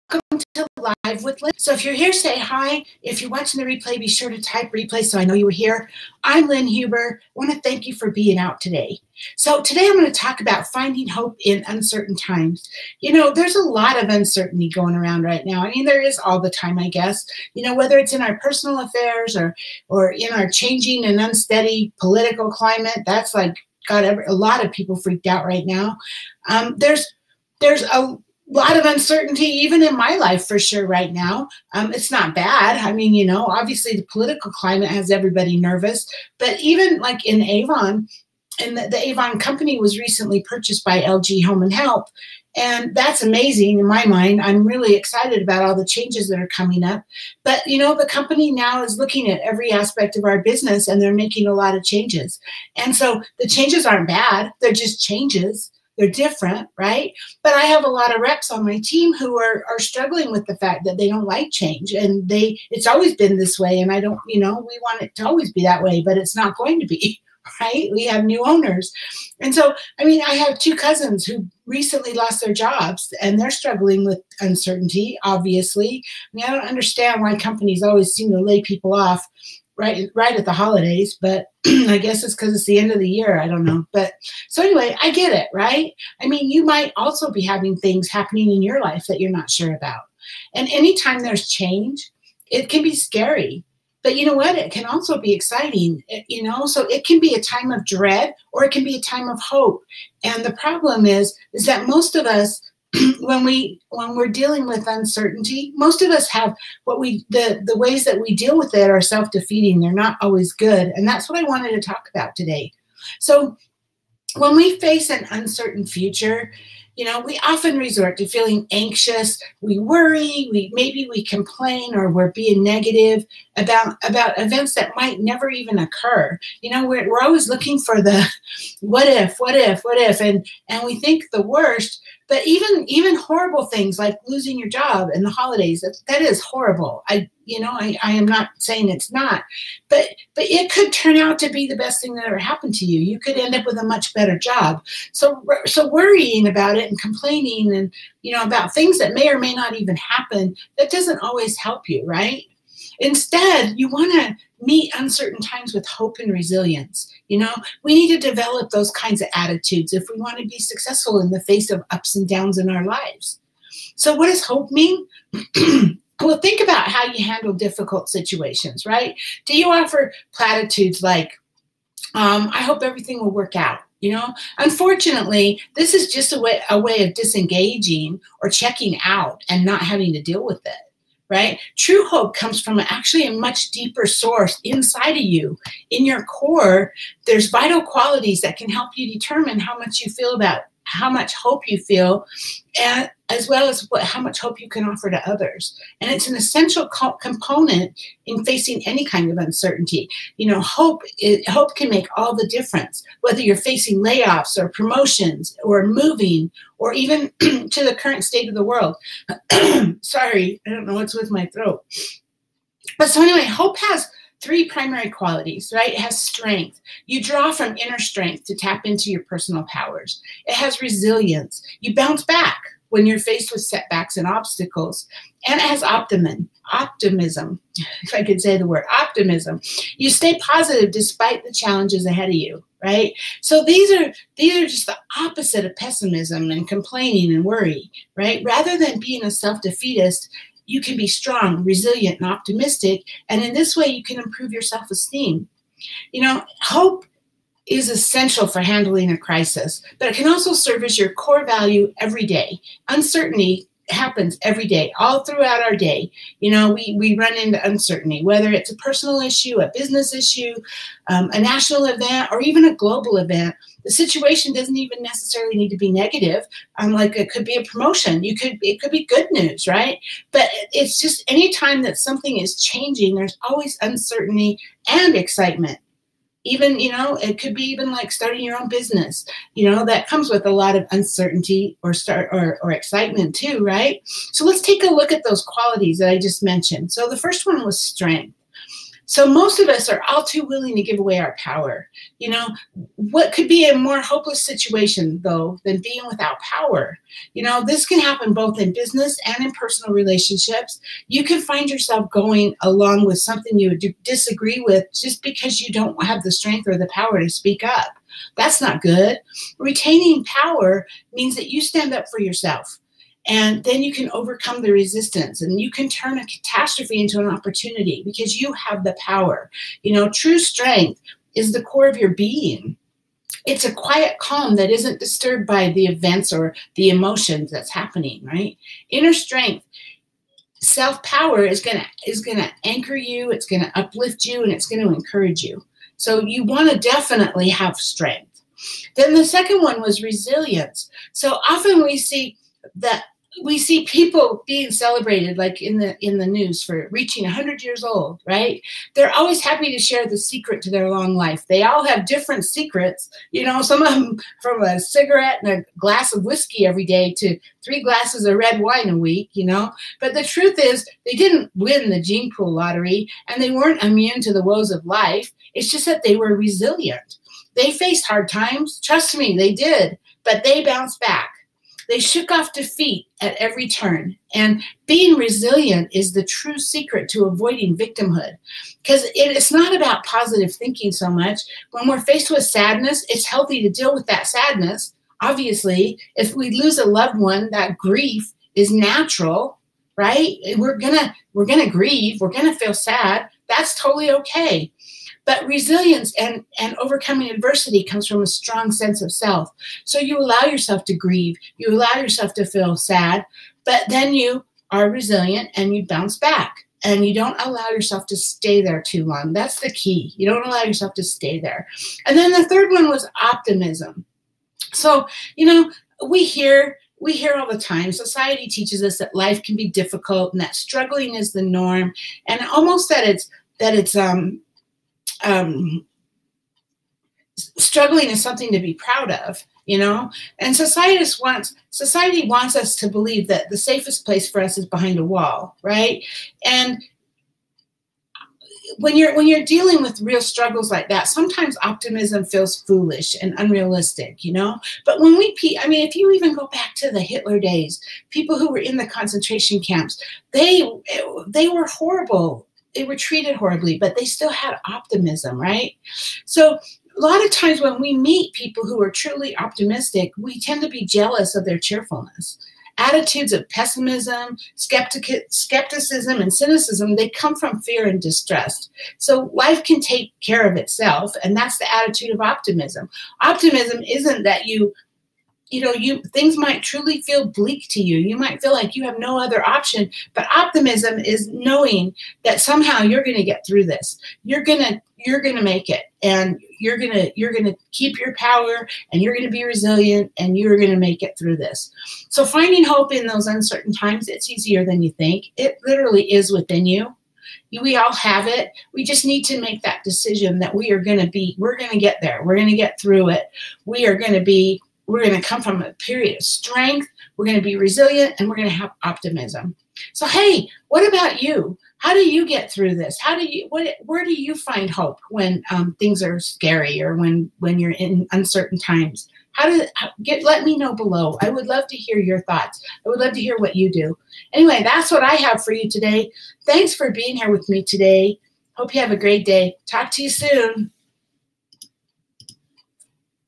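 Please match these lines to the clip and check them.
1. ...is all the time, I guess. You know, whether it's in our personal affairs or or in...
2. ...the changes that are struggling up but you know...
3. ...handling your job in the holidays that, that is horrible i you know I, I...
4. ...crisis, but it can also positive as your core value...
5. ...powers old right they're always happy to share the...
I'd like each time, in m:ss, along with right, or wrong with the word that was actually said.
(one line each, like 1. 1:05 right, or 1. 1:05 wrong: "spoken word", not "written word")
1. 0:16 right
2. 0:45 wrong: "coming", not "struggling"
3. 2:14 wrong: "losing", not "handling"
4. 4:09 wrong: "serve", not "positive"
5. 5:47 wrong: "years", not "powers".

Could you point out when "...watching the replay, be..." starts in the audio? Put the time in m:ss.
0:03.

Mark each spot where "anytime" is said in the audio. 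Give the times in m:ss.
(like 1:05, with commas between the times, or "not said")
1:30, 4:31.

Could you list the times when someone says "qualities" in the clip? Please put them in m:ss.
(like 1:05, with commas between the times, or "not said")
3:07, 3:35, 4:45.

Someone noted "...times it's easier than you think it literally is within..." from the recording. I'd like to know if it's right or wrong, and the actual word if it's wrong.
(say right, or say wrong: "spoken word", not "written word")
right.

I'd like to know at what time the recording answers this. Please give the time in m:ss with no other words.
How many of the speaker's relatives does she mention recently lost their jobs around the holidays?
1:10.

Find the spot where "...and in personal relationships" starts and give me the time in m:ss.
4:59.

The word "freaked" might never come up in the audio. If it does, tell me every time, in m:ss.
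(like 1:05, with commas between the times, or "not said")
0:24.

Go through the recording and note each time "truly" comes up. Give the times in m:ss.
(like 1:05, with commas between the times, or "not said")
7:38, 7:56.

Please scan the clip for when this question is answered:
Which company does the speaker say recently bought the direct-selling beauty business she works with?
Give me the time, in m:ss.
0:41.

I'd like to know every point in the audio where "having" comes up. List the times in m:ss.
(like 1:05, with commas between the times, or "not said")
1:27, 2:59.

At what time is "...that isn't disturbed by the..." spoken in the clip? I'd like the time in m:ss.
5:24.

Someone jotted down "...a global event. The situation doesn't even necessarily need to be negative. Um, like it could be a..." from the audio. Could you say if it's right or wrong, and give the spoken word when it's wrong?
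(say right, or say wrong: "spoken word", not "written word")
right.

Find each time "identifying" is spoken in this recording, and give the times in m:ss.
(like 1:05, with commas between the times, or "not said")
not said.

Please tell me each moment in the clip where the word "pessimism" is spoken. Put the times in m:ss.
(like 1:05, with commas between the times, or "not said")
3:55, 7:43.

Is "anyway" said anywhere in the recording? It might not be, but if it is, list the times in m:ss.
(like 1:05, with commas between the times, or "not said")
1:24, 3:33, 8:44.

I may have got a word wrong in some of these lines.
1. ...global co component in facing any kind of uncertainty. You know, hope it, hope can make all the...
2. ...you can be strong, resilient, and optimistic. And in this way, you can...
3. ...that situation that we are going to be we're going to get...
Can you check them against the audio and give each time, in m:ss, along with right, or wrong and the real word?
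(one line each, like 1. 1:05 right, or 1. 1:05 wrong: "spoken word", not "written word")
1. 3:16 wrong: "essential", not "global"
2. 4:00 right
3. 8:19 wrong: "decision", not "situation".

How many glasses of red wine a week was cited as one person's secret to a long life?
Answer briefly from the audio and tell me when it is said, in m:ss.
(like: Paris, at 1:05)
3, at 5:57.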